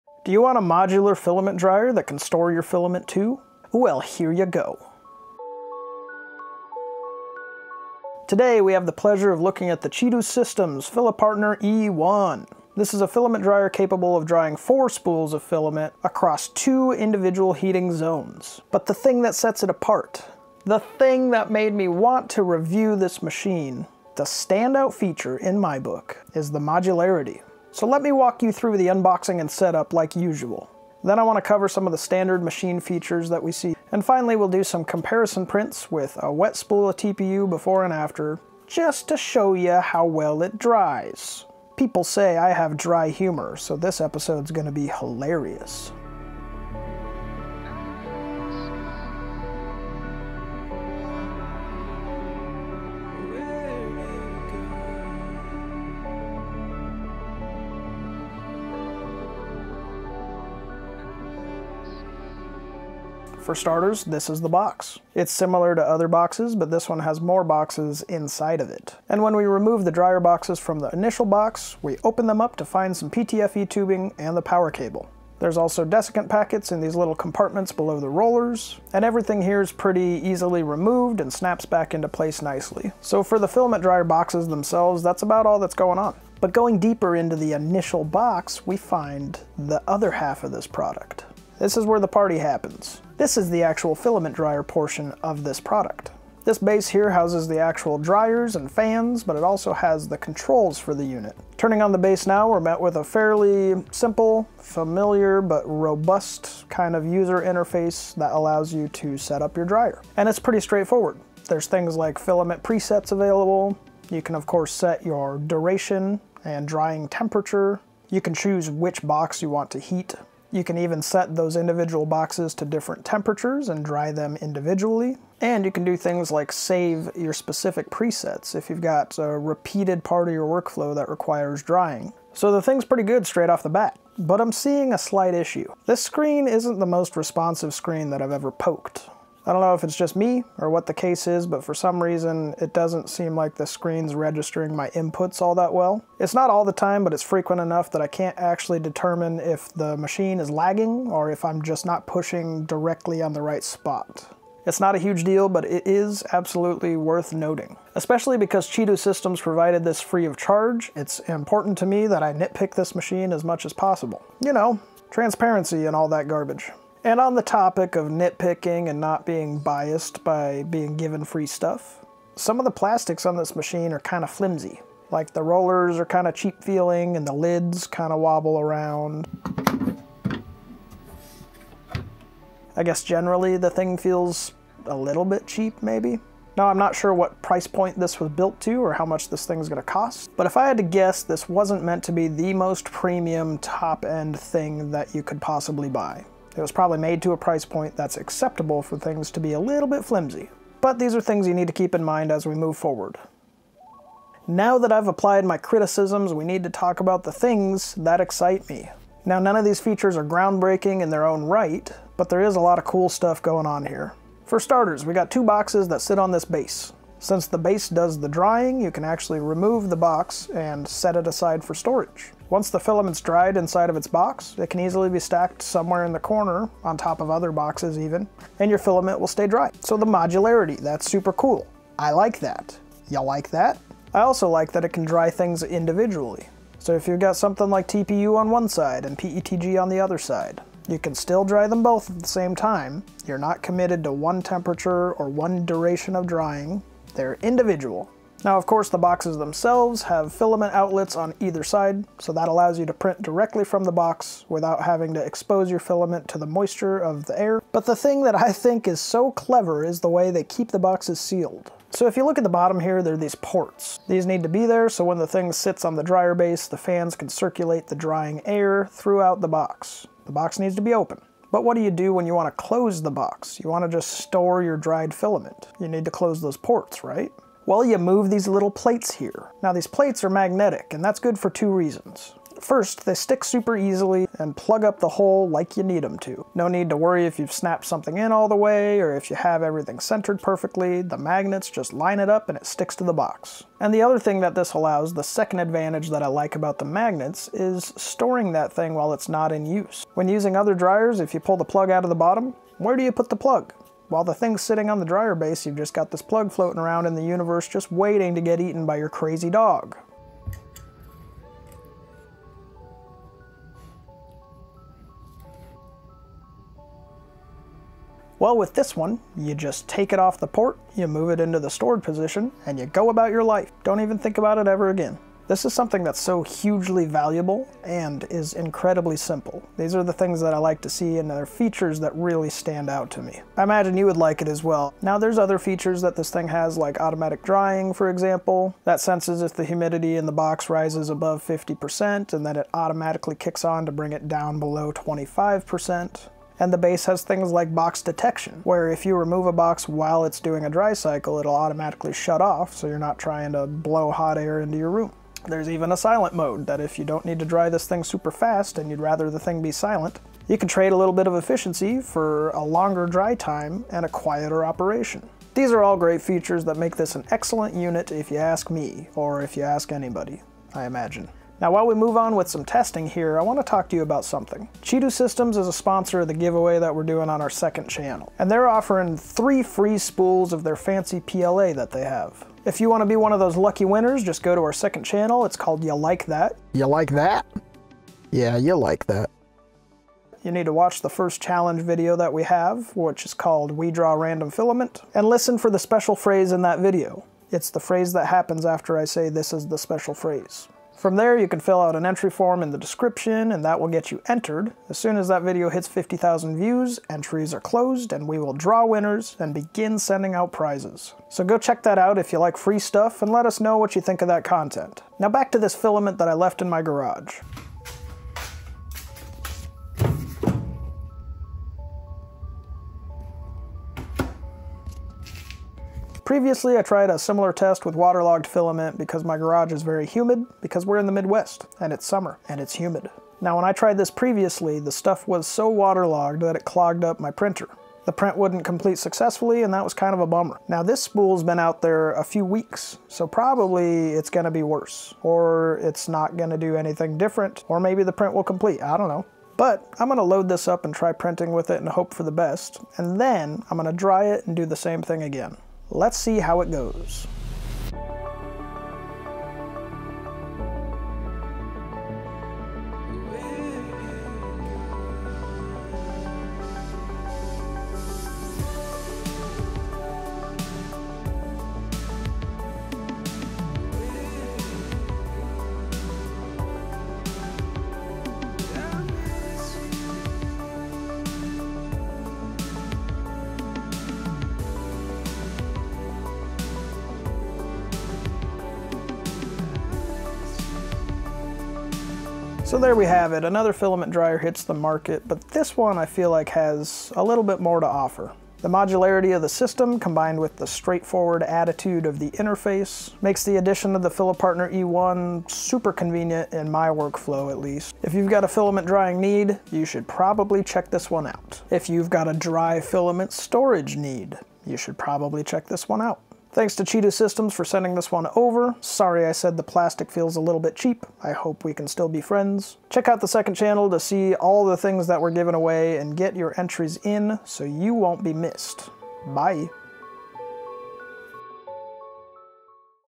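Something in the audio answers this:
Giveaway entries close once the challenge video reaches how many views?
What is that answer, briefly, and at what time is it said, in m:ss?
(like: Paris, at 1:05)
50,000, at 6:45.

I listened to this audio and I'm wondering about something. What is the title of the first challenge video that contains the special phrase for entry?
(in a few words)
We Draw Random Filament.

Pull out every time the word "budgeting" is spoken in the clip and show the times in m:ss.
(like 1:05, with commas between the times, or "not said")
not said.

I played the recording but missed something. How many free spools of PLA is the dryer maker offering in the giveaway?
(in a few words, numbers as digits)
3.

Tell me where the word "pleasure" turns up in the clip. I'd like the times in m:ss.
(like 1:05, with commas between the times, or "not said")
0:08.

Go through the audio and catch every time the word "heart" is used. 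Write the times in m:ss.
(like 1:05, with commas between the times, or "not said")
not said.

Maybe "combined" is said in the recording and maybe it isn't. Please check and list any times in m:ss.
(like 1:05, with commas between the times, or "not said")
8:19.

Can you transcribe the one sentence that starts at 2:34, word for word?
It's not a huge deal, but it is absolutely worth noting.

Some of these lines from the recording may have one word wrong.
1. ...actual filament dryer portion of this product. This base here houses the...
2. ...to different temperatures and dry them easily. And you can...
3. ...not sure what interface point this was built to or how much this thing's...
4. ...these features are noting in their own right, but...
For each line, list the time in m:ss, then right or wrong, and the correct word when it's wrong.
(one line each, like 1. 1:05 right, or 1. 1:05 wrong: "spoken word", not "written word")
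1. 1:33 right
2. 2:02 wrong: "individually", not "easily"
3. 3:06 wrong: "price", not "interface"
4. 3:29 wrong: "groundbreaking", not "noting".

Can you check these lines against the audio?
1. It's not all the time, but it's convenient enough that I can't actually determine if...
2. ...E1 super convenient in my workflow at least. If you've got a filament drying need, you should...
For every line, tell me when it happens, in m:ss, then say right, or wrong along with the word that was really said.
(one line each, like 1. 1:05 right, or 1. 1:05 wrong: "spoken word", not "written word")
1. 2:26 wrong: "frequent", not "convenient"
2. 8:24 right.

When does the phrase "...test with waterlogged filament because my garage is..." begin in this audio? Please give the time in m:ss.
7:07.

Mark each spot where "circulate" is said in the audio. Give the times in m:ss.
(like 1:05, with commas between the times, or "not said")
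4:27.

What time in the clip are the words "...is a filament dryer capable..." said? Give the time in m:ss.
0:12.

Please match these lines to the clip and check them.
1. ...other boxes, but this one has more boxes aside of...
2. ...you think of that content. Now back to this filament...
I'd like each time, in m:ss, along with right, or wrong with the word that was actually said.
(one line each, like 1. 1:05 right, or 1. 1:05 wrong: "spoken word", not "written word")
1. 1:05 wrong: "inside", not "aside"
2. 6:53 right.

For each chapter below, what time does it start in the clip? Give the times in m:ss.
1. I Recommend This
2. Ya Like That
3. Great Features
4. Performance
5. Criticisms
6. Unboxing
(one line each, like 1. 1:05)
1. 8:12
2. 6:11
3. 3:24
4. 6:54
5. 2:12
6. 1:03.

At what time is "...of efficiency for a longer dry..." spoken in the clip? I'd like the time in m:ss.
6:01.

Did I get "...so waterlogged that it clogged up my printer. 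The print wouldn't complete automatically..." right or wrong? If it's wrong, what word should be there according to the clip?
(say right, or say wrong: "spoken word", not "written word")
wrong: "successfully", not "automatically".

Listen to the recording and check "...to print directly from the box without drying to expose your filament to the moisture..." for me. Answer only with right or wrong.
wrong.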